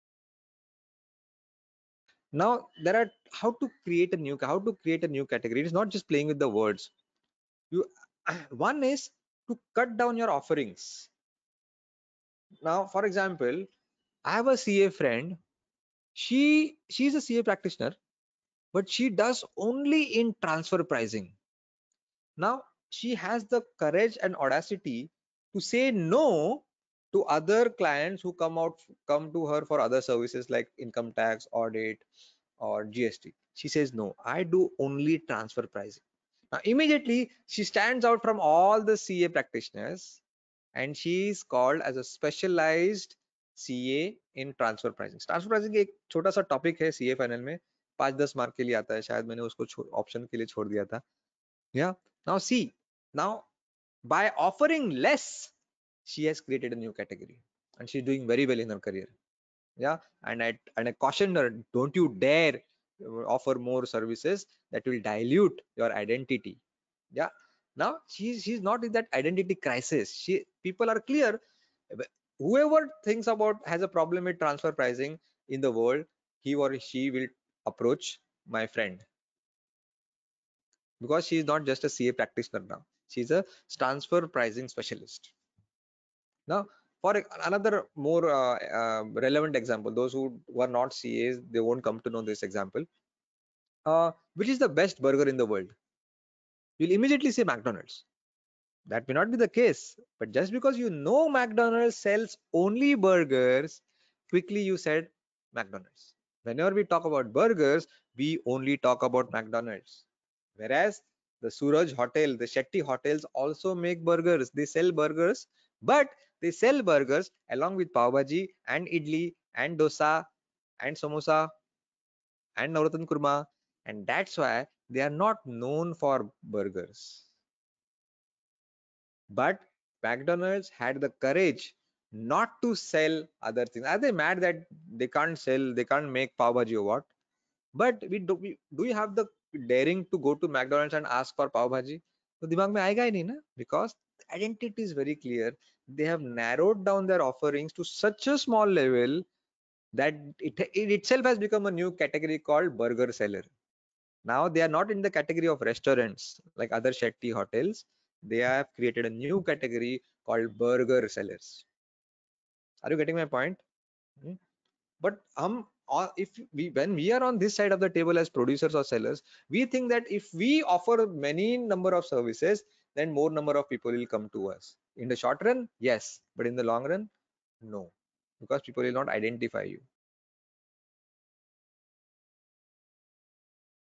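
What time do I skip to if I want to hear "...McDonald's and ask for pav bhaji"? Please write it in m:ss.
2:20.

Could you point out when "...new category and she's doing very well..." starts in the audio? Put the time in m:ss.
0:56.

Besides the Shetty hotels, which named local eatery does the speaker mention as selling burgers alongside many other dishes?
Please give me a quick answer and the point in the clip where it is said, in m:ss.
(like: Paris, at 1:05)
Suraj Hotel, at 1:51.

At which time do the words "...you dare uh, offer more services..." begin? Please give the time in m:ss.
1:01.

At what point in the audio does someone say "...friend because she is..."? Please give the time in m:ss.
1:18.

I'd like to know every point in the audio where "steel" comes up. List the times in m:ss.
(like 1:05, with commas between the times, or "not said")
not said.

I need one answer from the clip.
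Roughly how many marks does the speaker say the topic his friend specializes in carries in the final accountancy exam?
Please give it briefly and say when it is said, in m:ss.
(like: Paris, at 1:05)
5 to 10, at 0:47.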